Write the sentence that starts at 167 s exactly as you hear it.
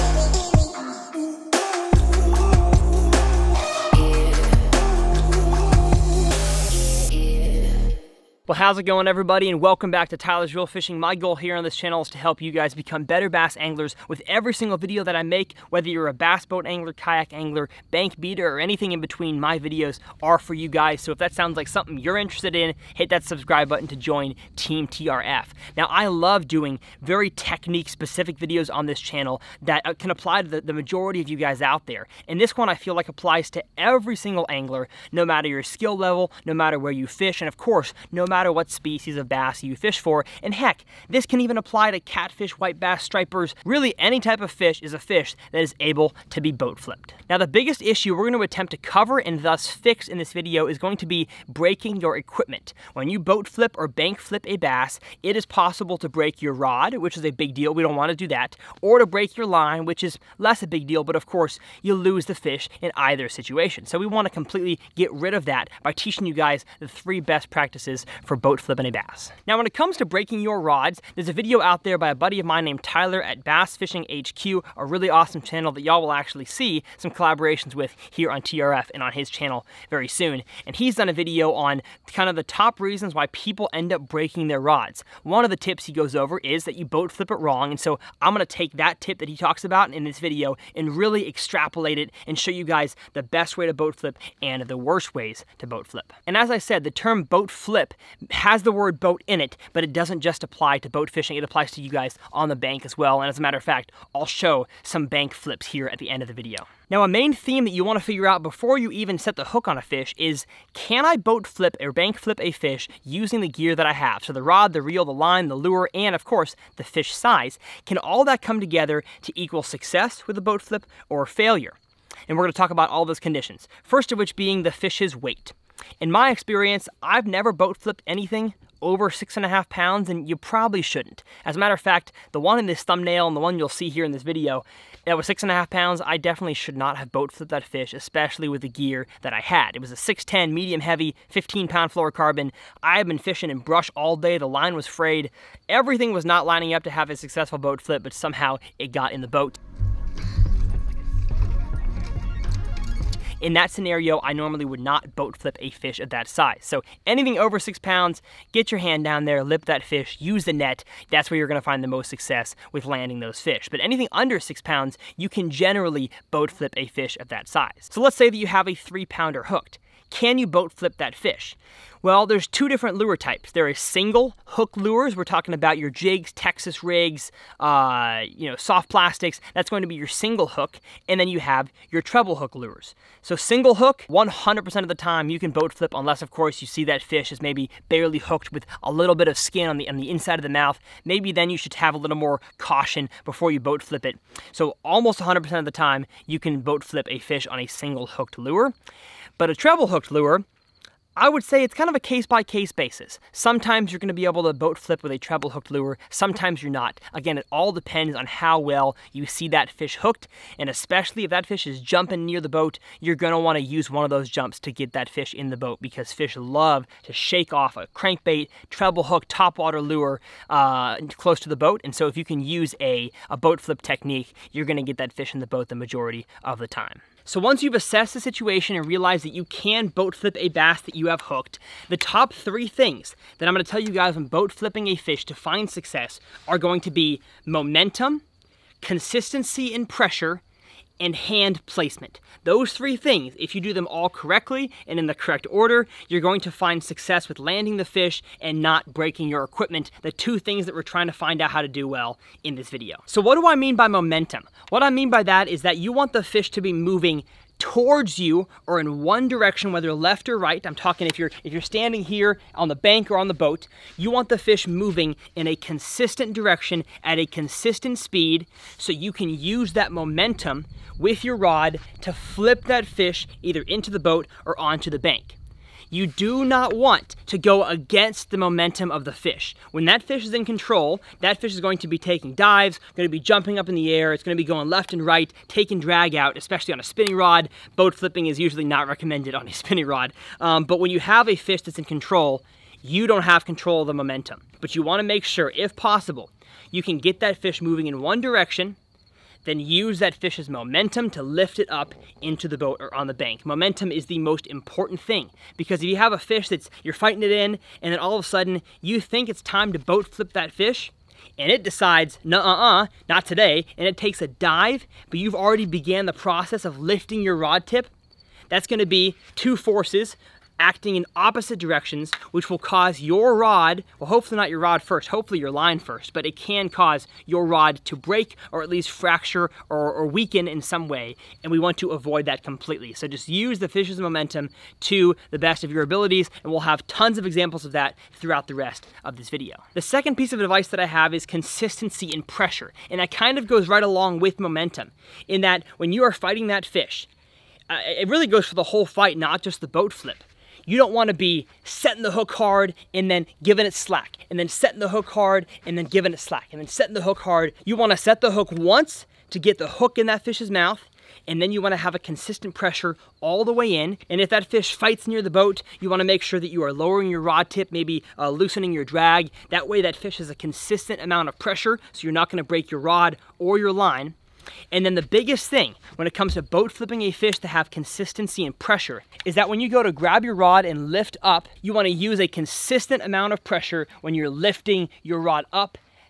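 So let's say that you have a three pounder hooked.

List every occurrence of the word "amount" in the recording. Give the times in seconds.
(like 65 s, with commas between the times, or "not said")
370 s, 383 s.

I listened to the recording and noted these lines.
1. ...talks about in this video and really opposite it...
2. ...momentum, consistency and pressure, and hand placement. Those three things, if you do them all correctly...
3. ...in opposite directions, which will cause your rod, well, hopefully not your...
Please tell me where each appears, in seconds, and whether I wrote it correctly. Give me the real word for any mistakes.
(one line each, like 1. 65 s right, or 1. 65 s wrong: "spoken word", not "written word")
1. 89 s wrong: "extrapolate", not "opposite"
2. 237 s right
3. 320 s right.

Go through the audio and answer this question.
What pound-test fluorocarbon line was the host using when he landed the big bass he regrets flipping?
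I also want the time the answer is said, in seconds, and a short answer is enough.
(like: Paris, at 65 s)
15 pound, at 141 s.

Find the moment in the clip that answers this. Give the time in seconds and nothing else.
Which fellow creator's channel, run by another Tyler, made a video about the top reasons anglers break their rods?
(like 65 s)
73 s.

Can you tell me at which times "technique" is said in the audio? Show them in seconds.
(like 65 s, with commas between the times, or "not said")
27 s, 223 s.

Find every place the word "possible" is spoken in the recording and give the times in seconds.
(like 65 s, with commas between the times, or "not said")
55 s, 295 s.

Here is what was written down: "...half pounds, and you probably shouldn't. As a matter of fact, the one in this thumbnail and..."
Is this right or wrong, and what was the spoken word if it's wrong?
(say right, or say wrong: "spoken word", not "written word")
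right.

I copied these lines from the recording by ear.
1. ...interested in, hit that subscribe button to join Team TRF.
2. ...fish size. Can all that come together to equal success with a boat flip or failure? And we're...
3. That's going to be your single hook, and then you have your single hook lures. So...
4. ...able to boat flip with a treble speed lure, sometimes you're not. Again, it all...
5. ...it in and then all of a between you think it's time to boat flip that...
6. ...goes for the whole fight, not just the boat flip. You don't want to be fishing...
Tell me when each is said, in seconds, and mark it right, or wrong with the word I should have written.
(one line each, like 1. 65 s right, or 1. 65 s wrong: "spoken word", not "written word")
1. 22 s right
2. 116 s right
3. 179 s wrong: "treble", not "single"
4. 204 s wrong: "hooked", not "speed"
5. 307 s wrong: "sudden", not "between"
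6. 348 s wrong: "setting", not "fishing".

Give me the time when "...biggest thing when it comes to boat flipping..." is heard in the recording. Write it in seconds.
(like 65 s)
375 s.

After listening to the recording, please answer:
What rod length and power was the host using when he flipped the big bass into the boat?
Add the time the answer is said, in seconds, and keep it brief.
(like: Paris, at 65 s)
610 medium heavy, at 139 s.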